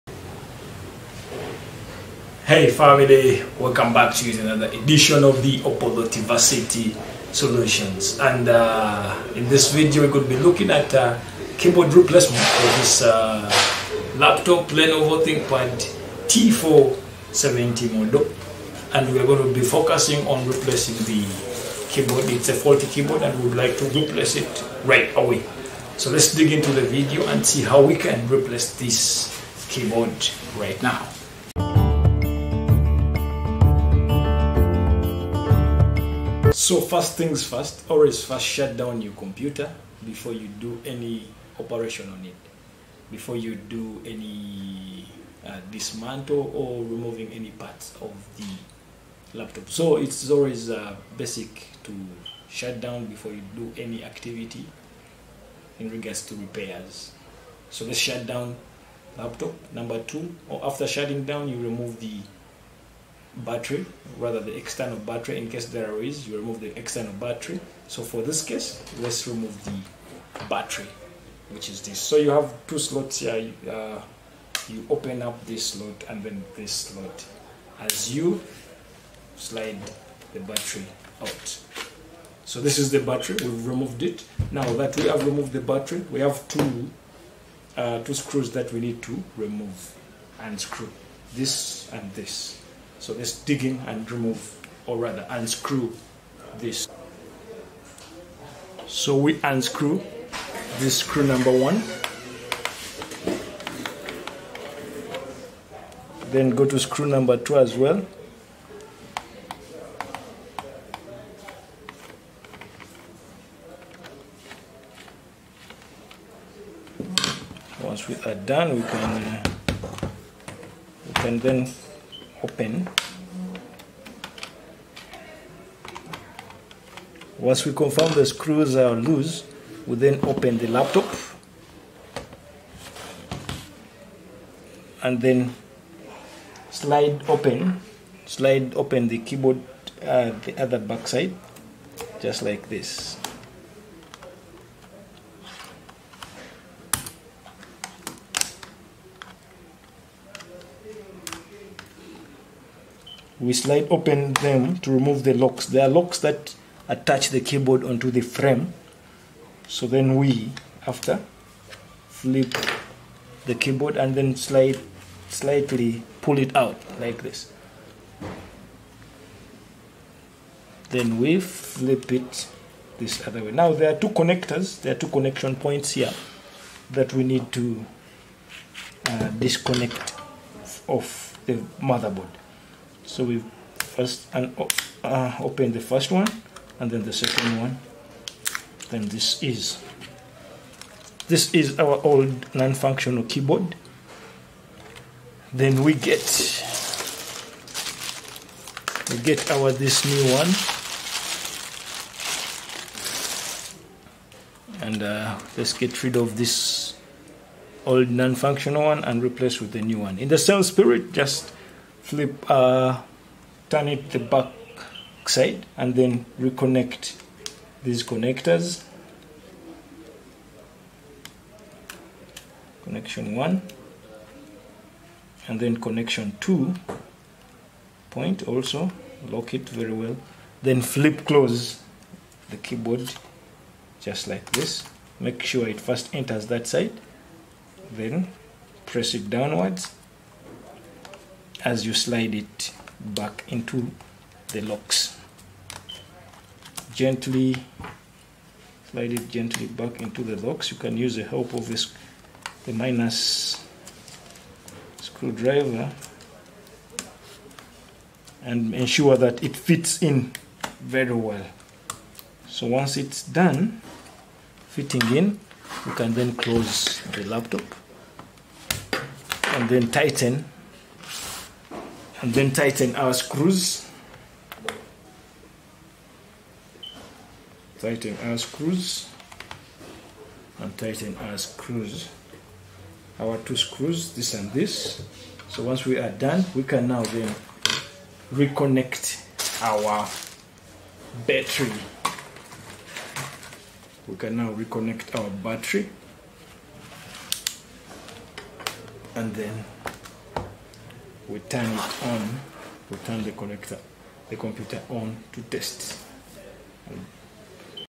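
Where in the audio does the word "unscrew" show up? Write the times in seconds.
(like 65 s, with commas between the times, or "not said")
95 s, 99 s.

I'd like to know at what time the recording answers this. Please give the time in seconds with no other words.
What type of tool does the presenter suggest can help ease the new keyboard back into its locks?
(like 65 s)
252 s.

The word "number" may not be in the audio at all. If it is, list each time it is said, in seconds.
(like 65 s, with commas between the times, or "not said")
59 s, 101 s, 107 s.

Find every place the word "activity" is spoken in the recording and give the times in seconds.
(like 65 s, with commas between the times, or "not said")
54 s.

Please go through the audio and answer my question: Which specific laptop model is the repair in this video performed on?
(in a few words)
Lenovo ThinkPad T470.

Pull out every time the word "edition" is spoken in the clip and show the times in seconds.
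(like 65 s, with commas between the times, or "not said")
4 s.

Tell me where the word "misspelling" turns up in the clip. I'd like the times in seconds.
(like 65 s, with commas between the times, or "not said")
not said.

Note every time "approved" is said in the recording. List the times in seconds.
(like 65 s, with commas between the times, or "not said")
not said.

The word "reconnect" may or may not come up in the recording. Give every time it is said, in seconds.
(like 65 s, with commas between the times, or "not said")
216 s, 288 s, 294 s.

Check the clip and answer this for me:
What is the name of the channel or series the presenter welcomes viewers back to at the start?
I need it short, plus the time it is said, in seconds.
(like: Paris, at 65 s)
Opolotiversity Solutions, at 5 s.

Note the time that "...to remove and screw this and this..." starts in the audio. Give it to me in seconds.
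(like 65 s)
89 s.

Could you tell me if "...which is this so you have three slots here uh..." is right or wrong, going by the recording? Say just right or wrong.
wrong.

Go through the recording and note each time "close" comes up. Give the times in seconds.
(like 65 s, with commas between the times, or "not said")
231 s, 266 s.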